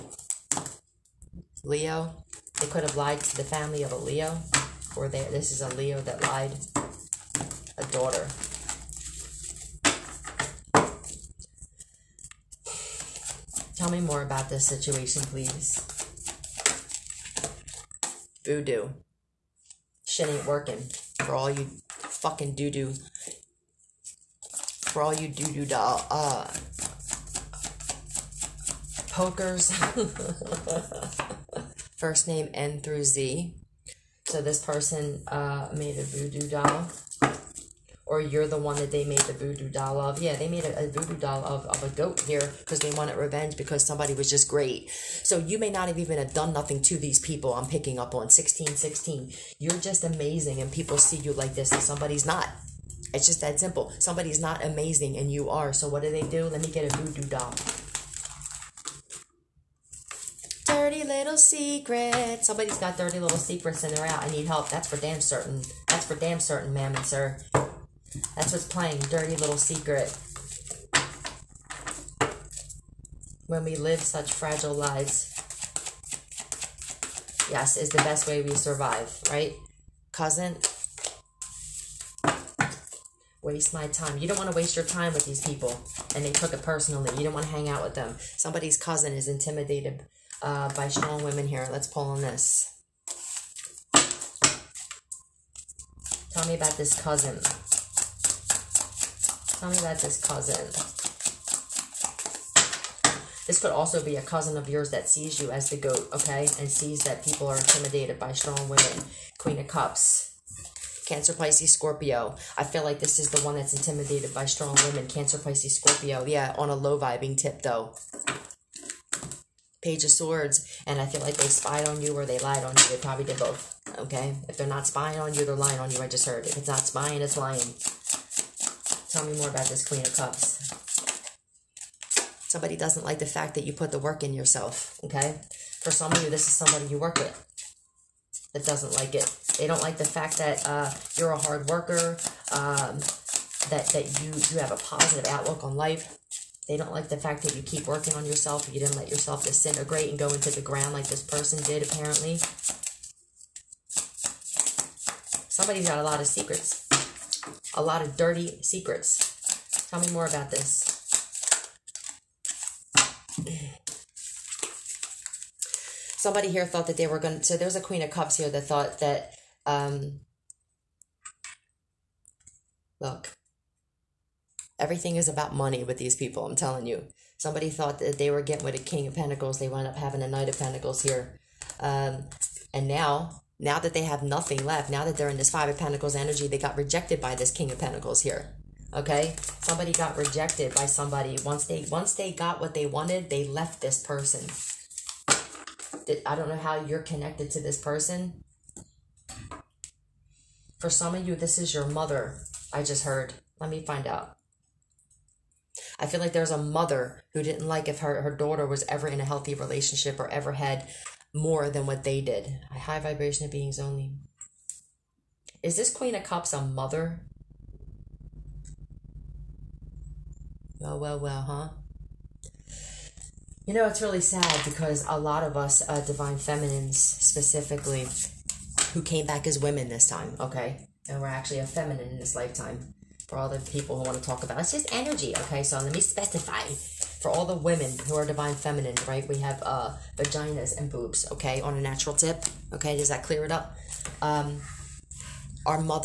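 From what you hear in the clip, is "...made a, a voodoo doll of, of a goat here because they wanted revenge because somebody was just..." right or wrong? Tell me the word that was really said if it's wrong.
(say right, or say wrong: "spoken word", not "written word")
right.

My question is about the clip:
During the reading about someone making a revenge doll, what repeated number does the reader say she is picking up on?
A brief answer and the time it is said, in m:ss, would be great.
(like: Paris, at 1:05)
1616, at 0:48.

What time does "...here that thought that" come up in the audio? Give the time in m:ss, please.
2:48.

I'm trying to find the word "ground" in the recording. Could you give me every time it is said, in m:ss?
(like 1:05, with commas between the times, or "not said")
2:30.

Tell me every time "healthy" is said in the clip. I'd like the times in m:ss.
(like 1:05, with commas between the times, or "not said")
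3:29.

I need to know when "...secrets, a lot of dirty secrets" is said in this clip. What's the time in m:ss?
2:36.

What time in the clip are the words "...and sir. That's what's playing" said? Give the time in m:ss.
1:06.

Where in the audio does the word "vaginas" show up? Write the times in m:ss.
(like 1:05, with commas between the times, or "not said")
4:00.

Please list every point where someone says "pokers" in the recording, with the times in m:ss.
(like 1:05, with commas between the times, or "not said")
0:29.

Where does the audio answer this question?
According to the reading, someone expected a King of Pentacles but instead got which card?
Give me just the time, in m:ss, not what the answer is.
3:00.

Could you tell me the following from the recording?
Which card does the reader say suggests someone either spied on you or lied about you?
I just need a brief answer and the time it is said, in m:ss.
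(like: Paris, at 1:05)
Page of Swords, at 1:59.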